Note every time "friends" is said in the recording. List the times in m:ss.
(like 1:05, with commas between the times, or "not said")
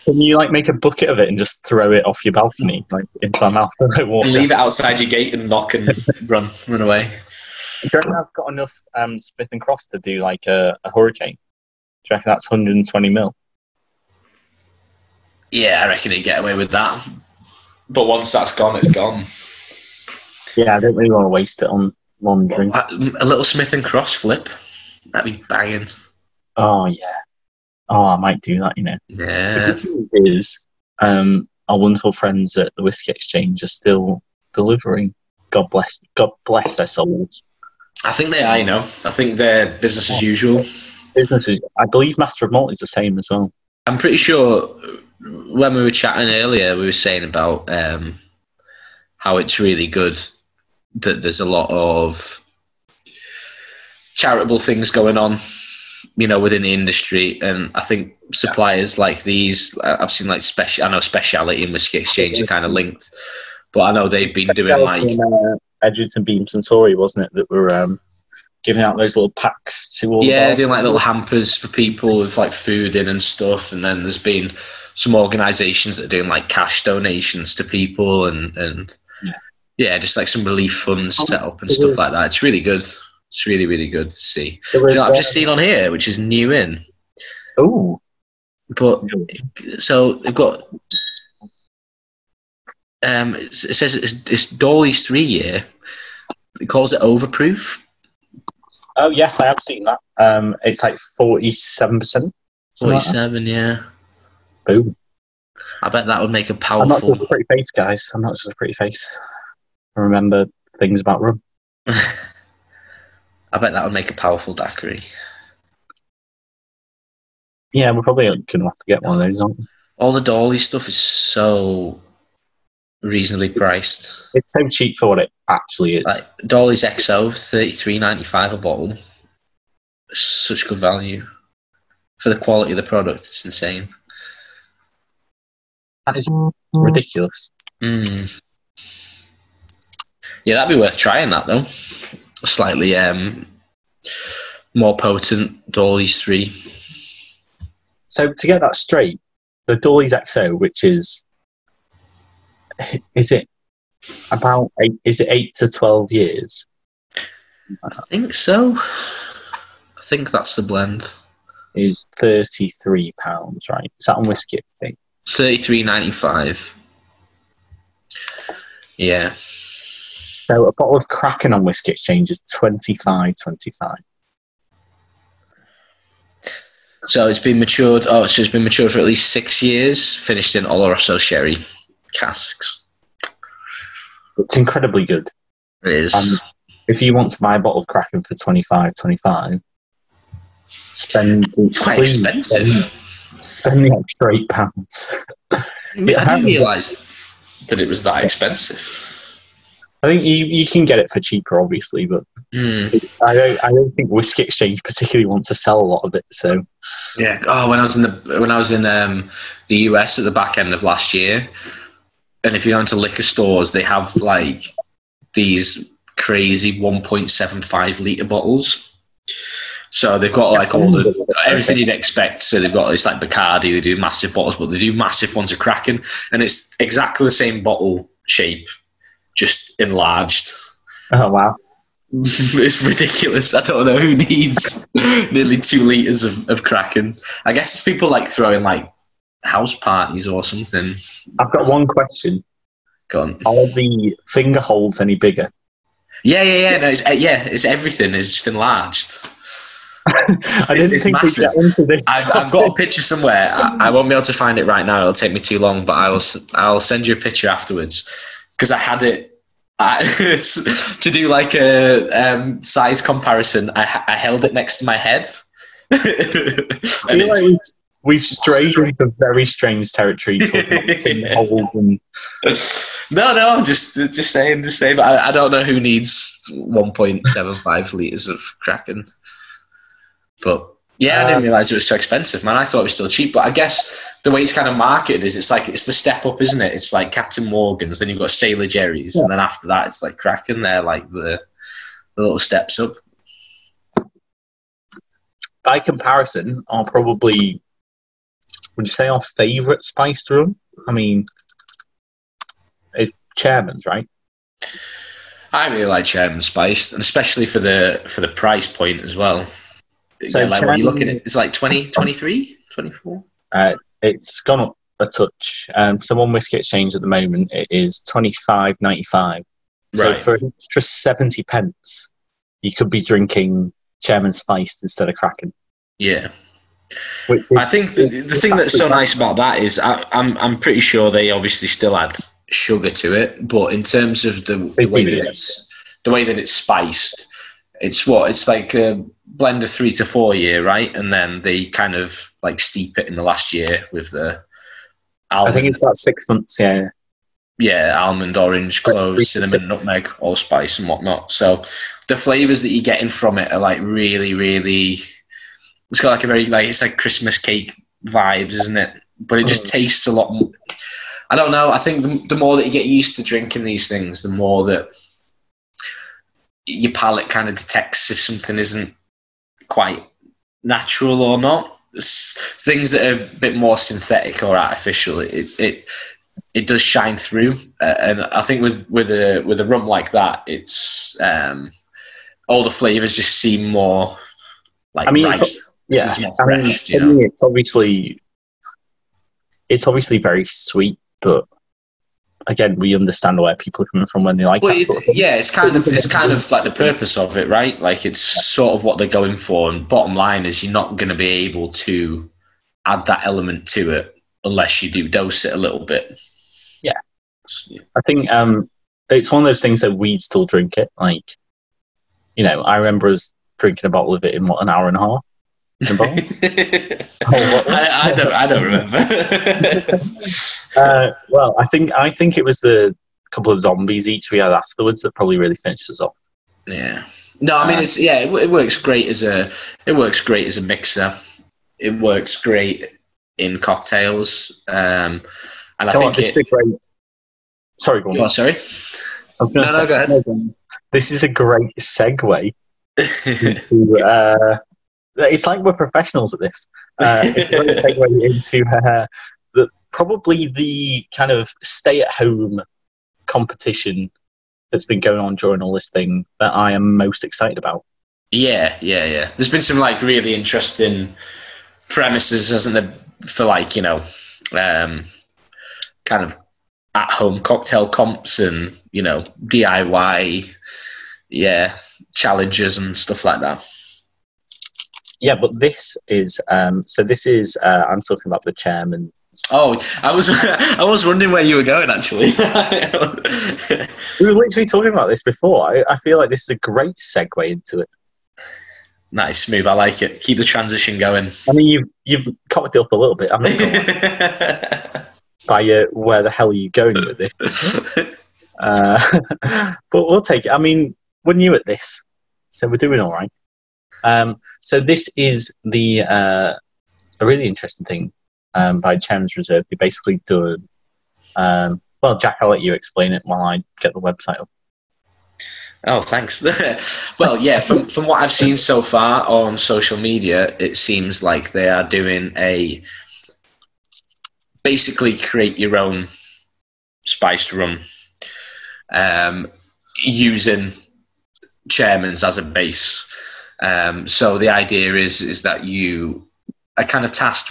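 0:32.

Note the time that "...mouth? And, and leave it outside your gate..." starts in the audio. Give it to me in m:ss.
0:03.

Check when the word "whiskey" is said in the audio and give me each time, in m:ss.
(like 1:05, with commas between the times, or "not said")
0:32, 1:01, 2:44, 2:51, 3:24, 5:16.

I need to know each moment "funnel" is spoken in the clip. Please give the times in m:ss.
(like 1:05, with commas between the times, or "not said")
not said.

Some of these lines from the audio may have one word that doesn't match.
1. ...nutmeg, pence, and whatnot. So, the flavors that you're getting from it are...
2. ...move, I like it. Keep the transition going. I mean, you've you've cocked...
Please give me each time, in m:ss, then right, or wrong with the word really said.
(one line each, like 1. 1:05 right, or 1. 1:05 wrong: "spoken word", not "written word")
1. 5:49 wrong: "allspice", not "pence"
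2. 8:09 right.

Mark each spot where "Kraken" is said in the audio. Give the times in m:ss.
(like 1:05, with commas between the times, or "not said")
2:51, 3:07, 3:45, 3:56, 4:38, 4:50, 5:25.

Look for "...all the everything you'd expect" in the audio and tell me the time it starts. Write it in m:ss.
3:40.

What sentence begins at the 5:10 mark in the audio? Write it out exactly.
So yeah, like you looking at?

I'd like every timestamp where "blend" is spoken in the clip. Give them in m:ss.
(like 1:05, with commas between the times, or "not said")
2:40, 5:39.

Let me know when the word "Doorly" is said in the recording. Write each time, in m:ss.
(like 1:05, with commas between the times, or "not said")
1:34, 2:00, 2:06, 2:25, 2:29.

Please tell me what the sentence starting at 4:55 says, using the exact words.
By comparison, are probably would you say our favorite spice rum?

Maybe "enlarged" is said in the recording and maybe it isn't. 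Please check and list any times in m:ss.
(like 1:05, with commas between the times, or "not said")
3:49, 4:08.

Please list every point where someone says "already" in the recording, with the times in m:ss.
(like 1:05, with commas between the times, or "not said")
not said.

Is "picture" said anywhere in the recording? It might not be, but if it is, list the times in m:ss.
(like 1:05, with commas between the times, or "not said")
4:12, 4:17.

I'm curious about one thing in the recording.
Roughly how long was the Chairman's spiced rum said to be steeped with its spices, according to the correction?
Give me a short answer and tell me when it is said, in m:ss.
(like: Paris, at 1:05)
6 months, at 5:45.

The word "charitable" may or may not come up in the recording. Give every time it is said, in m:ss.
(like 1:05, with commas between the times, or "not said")
0:54.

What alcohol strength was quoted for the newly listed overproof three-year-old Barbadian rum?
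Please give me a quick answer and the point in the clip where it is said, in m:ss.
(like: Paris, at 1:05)
47%, at 1:41.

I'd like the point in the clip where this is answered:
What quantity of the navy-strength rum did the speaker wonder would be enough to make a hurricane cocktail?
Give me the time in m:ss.
0:12.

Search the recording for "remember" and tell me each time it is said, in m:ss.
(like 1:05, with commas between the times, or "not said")
1:50, 6:52, 6:58.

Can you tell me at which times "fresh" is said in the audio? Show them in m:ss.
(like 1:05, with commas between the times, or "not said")
6:26.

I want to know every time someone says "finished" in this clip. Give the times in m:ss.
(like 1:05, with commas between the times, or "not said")
3:00, 7:05.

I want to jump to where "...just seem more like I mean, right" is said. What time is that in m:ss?
6:23.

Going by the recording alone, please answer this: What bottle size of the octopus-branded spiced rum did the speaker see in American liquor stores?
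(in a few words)
1.75 liters.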